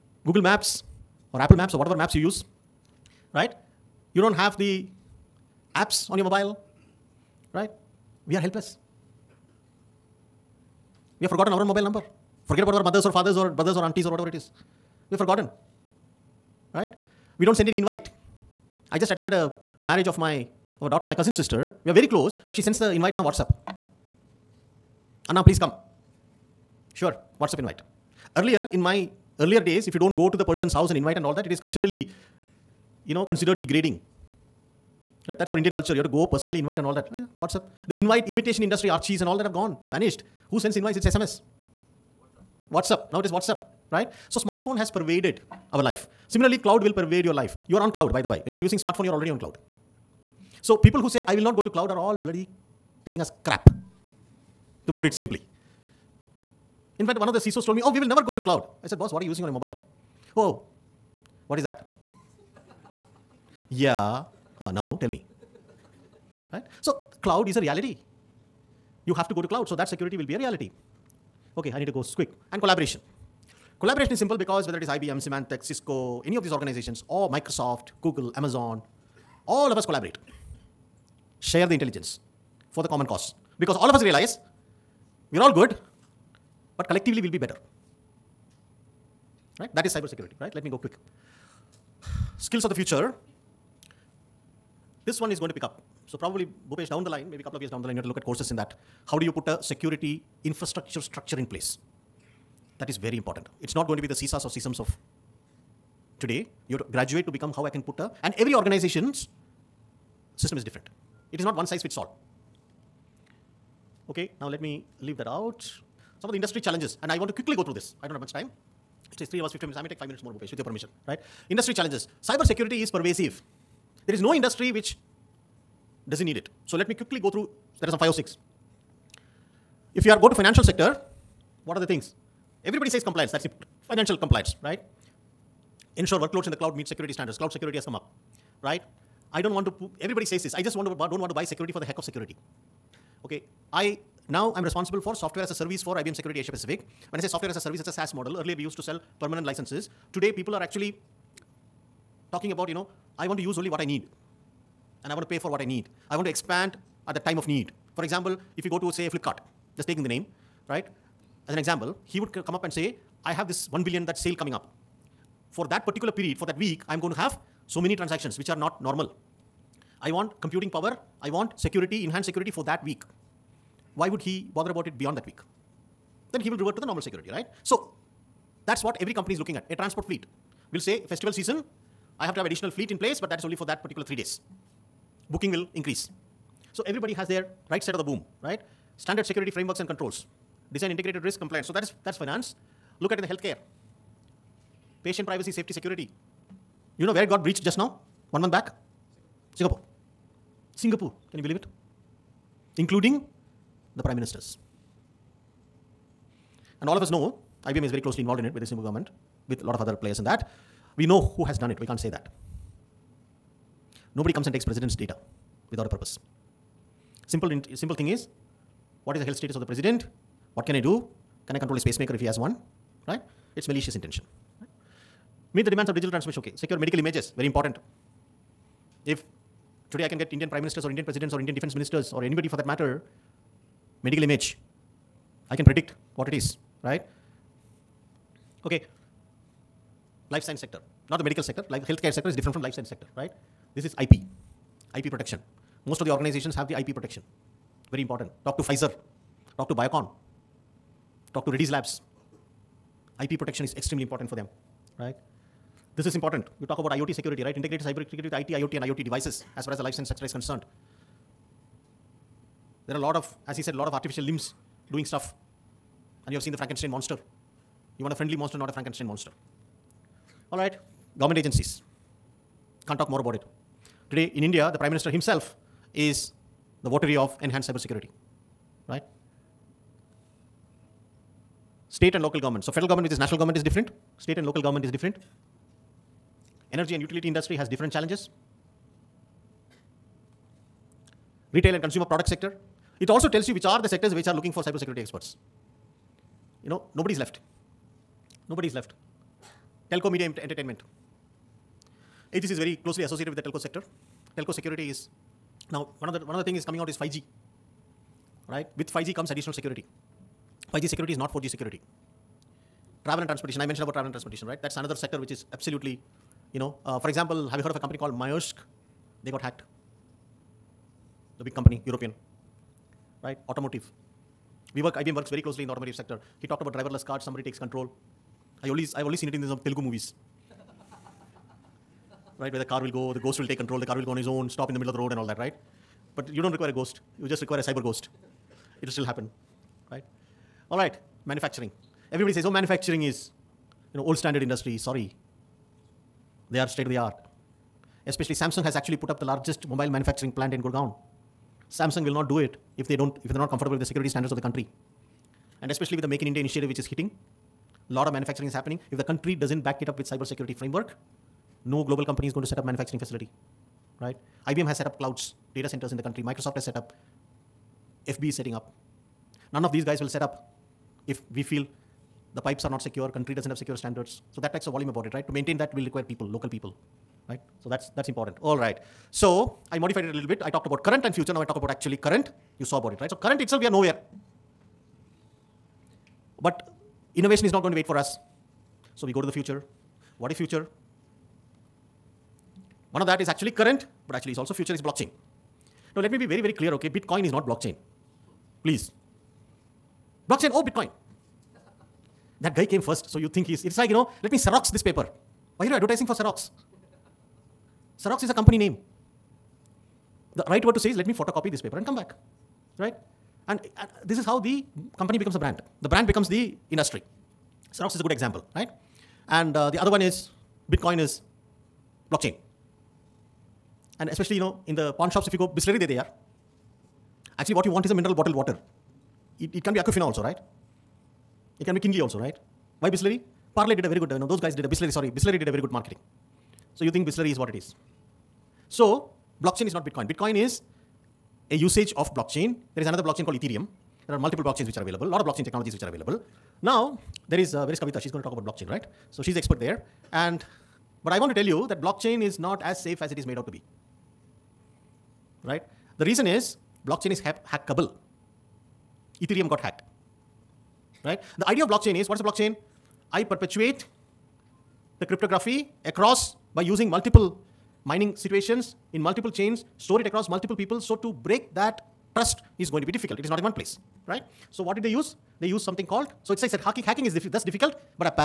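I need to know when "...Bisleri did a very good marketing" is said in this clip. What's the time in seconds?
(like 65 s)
435 s.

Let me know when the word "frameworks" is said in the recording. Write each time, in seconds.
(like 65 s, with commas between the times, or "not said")
189 s, 360 s.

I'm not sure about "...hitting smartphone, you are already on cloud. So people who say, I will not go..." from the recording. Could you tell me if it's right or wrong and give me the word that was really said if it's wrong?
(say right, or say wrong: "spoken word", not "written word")
wrong: "using", not "hitting".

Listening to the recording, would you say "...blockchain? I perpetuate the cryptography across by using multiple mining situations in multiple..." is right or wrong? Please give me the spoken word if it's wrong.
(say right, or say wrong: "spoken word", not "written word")
right.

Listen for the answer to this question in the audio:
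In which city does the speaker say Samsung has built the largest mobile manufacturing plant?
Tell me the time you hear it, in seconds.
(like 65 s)
350 s.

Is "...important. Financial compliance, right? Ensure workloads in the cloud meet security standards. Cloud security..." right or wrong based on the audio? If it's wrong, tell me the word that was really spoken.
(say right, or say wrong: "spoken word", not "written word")
right.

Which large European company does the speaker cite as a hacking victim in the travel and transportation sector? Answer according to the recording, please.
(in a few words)
Maersk.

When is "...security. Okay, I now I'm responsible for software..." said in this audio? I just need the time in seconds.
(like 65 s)
142 s.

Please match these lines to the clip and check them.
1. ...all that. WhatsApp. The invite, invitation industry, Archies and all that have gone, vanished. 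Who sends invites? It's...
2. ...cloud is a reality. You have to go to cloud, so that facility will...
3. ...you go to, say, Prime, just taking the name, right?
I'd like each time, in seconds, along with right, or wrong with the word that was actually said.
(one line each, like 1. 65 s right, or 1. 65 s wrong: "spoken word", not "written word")
1. 36 s right
2. 67 s wrong: "security", not "facility"
3. 158 s wrong: "Flipkart", not "Prime".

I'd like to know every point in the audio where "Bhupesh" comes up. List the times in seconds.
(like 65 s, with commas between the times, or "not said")
96 s, 120 s.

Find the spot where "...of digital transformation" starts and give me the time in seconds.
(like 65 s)
225 s.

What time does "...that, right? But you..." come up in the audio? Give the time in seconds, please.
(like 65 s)
335 s.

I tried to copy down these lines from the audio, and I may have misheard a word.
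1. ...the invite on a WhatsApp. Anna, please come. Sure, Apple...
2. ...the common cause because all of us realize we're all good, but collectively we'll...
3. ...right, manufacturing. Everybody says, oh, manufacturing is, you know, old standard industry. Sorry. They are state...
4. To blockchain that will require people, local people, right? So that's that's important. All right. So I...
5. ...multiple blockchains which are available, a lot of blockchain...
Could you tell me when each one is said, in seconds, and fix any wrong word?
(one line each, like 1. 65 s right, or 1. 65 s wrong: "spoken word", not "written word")
1. 22 s wrong: "WhatsApp", not "Apple"
2. 82 s right
3. 340 s right
4. 375 s wrong: "maintain", not "blockchain"
5. 444 s right.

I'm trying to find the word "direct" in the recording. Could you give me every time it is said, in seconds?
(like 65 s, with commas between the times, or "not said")
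not said.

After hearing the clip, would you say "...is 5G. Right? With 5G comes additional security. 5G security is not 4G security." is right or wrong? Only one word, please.
right.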